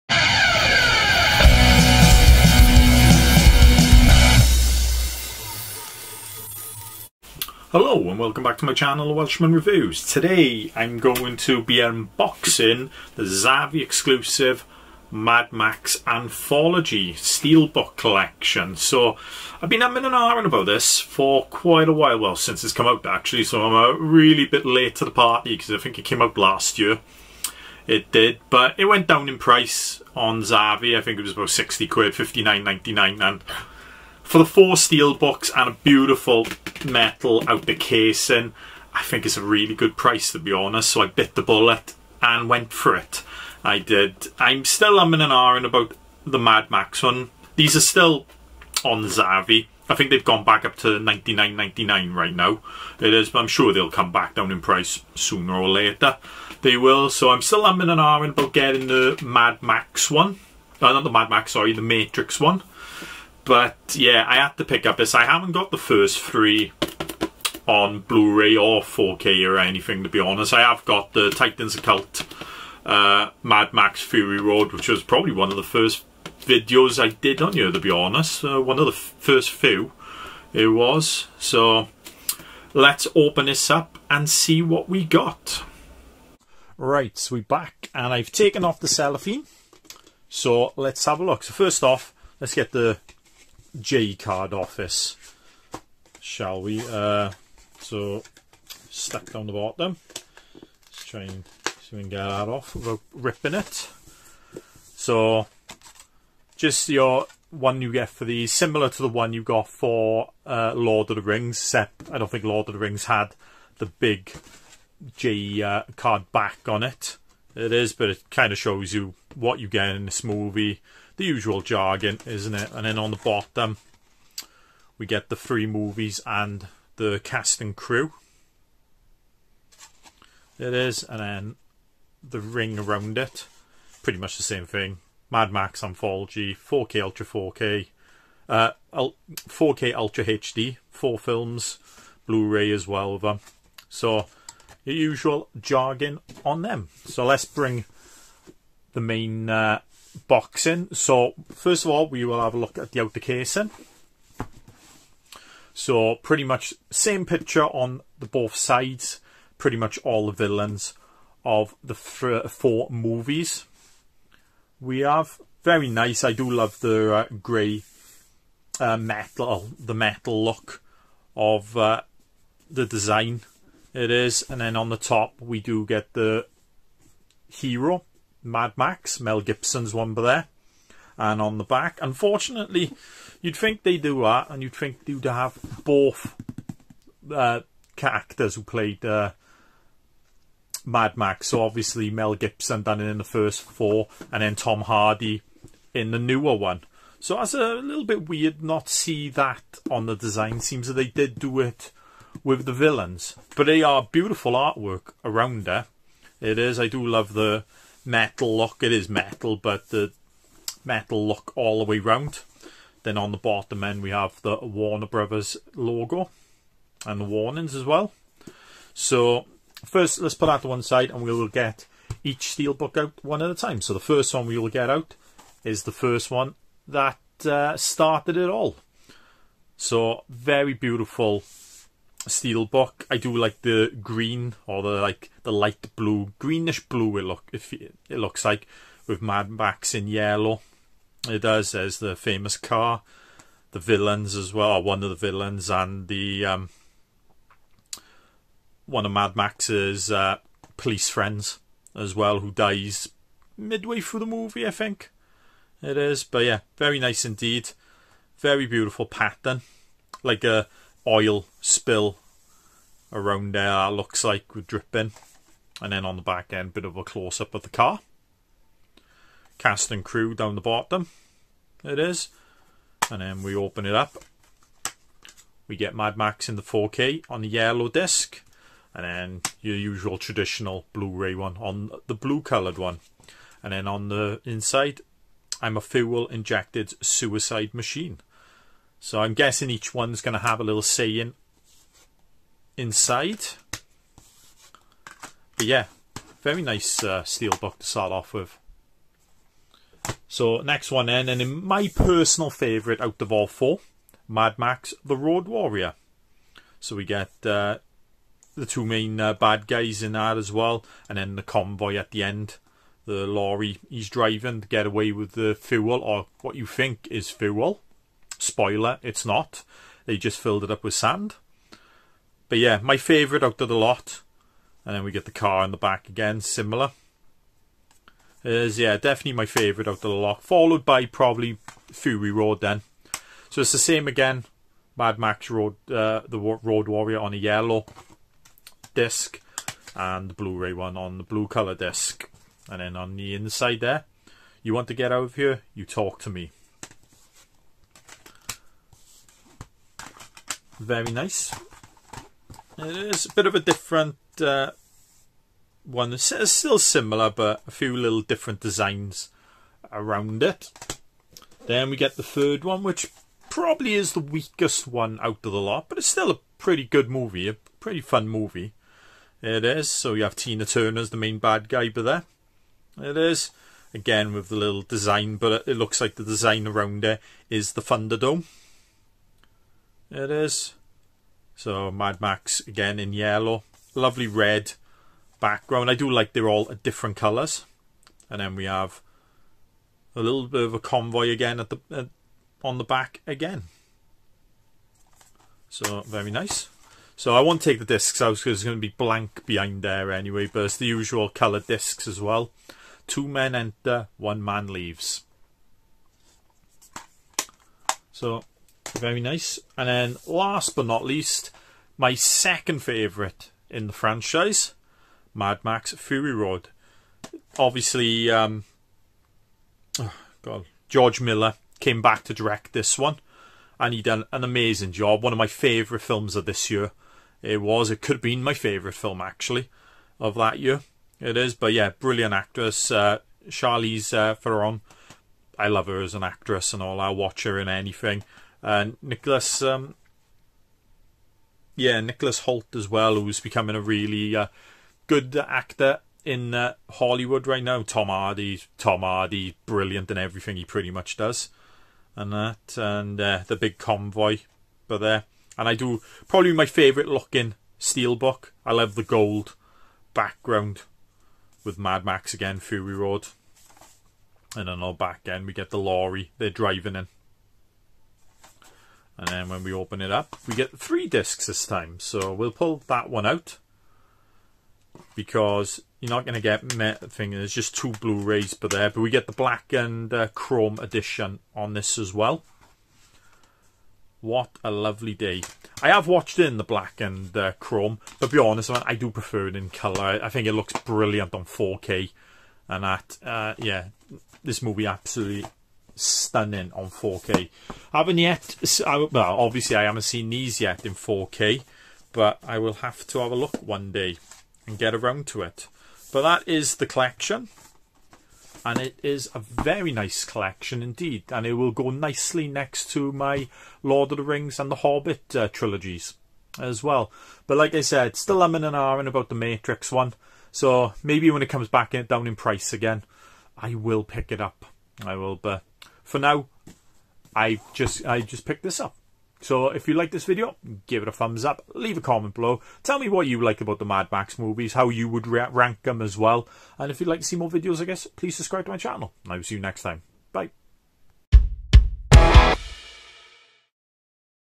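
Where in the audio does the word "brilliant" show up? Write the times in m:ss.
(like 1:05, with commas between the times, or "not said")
7:11, 7:29, 8:10.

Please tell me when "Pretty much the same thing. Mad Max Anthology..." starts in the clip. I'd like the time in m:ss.
2:14.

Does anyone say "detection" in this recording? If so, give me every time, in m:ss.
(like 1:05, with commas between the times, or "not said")
not said.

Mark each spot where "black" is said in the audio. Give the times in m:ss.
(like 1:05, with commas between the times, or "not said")
7:59, 8:06.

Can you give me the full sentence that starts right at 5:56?
It's, still similar, but a few little different designs around it.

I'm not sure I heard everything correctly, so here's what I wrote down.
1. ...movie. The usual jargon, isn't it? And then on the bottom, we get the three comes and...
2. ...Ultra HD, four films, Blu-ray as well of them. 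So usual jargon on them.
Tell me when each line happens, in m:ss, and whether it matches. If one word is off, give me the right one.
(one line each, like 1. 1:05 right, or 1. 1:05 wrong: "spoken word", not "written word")
1. 2:00 wrong: "movies", not "comes"
2. 2:19 right.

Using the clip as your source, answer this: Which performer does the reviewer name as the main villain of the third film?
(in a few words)
Tina Turner.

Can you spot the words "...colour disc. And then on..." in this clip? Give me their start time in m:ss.
5:41.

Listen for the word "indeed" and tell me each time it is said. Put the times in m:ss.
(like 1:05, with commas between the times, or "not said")
4:17, 8:30.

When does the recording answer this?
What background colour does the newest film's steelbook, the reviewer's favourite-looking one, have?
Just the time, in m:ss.
7:39.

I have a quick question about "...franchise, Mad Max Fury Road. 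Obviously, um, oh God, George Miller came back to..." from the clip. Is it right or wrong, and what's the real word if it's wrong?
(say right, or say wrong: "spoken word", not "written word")
right.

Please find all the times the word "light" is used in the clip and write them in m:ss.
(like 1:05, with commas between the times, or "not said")
3:55.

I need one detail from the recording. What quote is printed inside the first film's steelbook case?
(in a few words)
I'm a fuel injected suicide machine.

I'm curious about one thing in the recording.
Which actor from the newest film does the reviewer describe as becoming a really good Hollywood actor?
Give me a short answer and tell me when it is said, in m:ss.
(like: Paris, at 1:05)
Nicholas Hoult, at 7:22.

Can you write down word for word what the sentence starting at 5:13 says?
The lorry he's driving to get away with the fuel, or what you think is fuel.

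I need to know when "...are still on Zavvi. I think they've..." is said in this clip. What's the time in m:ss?
0:47.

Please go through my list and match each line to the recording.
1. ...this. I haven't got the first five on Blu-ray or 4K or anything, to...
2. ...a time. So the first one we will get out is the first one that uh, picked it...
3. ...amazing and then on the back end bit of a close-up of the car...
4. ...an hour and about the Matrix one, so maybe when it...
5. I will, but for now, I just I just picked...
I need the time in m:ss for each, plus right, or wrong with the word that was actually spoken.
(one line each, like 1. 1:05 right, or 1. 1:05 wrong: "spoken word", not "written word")
1. 1:04 wrong: "three", not "five"
2. 3:43 wrong: "started", not "picked"
3. 4:24 wrong: "dripping", not "amazing"
4. 8:38 right
5. 8:45 right.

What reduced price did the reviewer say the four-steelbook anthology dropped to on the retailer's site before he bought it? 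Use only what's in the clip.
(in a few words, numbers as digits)
£59.99.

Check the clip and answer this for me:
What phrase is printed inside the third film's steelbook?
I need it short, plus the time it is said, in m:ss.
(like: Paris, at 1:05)
Two men enter, one man leaves, at 6:43.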